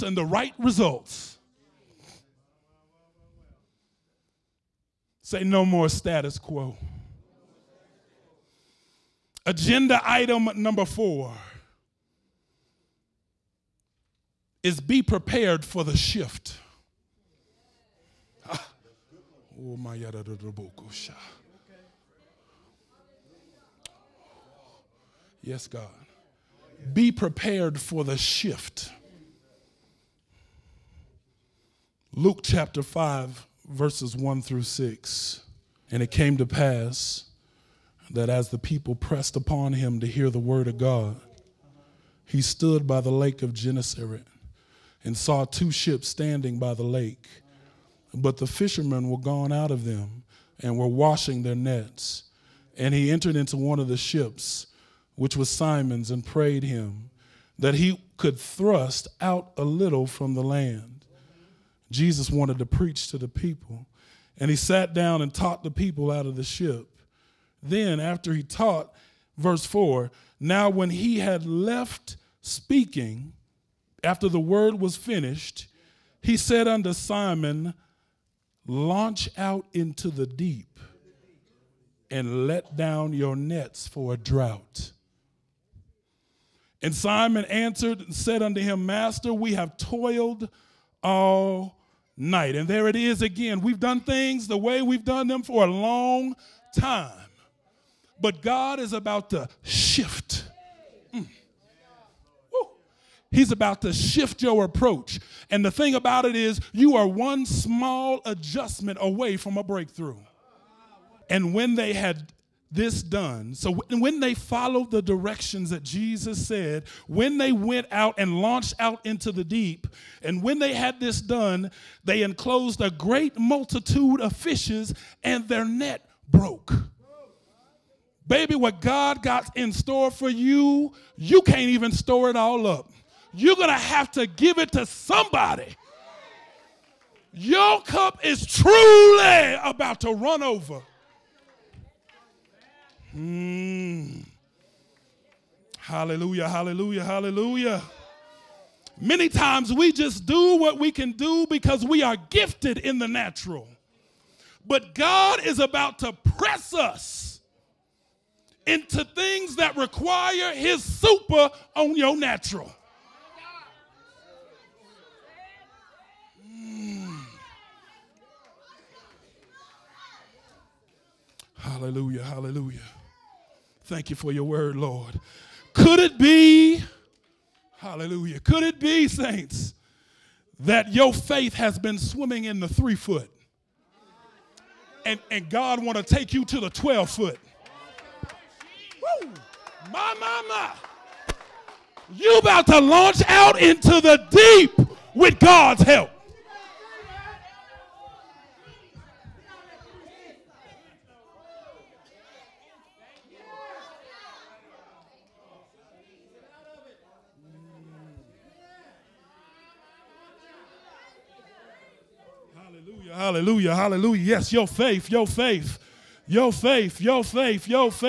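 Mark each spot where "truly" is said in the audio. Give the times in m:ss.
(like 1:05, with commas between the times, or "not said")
2:18.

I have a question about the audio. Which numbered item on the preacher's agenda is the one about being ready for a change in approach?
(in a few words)
4.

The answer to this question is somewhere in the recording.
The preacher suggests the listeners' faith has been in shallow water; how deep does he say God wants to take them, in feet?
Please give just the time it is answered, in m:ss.
3:06.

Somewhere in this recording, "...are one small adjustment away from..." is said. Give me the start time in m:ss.
1:46.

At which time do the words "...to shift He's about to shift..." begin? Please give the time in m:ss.
1:39.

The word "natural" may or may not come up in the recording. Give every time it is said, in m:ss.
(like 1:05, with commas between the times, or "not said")
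2:33, 2:42.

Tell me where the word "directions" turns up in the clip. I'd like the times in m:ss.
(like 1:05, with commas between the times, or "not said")
1:55.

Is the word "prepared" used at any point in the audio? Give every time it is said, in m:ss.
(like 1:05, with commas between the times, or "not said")
0:15, 0:27.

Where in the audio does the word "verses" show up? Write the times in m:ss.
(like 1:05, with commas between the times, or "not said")
0:33, 1:09.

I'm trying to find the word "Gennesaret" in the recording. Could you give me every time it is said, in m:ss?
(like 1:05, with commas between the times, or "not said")
0:43.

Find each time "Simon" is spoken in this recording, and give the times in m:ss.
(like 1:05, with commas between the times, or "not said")
0:55, 1:16, 1:26.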